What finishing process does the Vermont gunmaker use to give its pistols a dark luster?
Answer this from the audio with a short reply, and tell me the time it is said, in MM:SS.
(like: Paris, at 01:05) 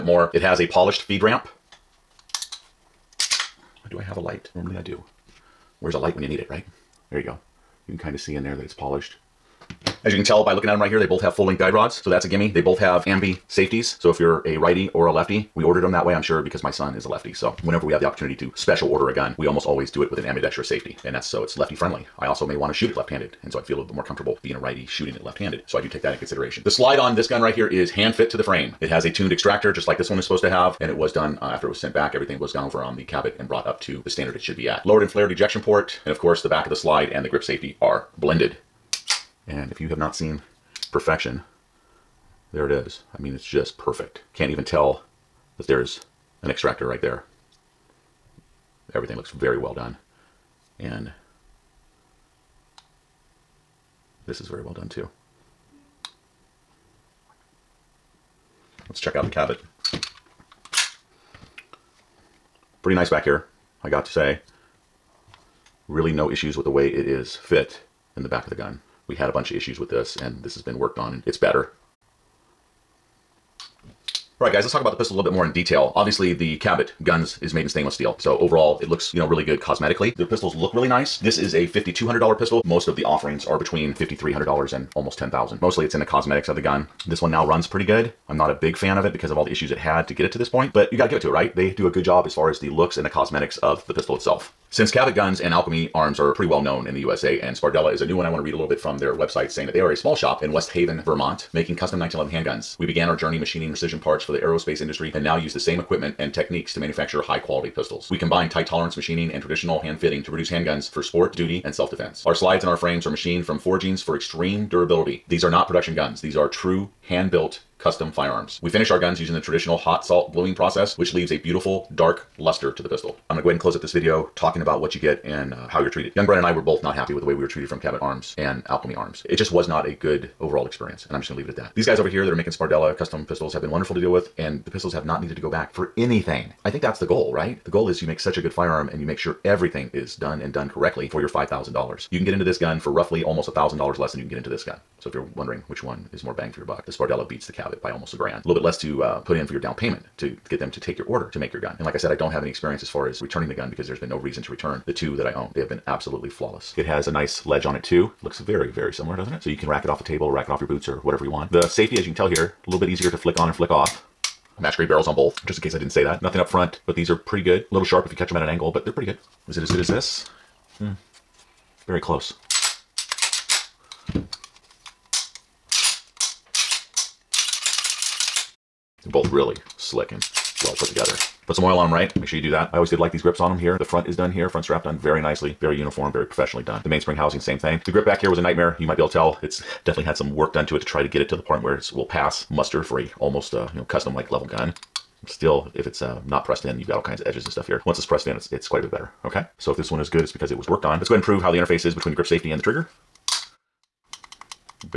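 Hot salt bluing, at 01:59.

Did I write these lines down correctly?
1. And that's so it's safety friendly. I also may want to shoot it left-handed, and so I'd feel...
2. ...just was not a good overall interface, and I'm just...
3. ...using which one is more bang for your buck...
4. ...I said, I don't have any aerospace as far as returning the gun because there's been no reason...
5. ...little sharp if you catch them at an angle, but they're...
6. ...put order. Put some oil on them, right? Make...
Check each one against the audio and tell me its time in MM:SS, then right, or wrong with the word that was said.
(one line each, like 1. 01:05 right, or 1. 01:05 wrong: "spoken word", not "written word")
1. 00:21 wrong: "lefty", not "safety"
2. 02:09 wrong: "experience", not "interface"
3. 02:25 wrong: "wondering", not "using"
4. 02:31 wrong: "experience", not "aerospace"
5. 02:47 right
6. 03:00 wrong: "together", not "order".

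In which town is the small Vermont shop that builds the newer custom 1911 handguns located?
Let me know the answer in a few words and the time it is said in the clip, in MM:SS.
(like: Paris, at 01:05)
West Haven, at 01:40.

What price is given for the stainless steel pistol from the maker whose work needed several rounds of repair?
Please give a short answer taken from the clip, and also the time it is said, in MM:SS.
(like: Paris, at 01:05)
$5,200, at 01:21.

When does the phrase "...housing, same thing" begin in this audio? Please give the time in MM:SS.
03:07.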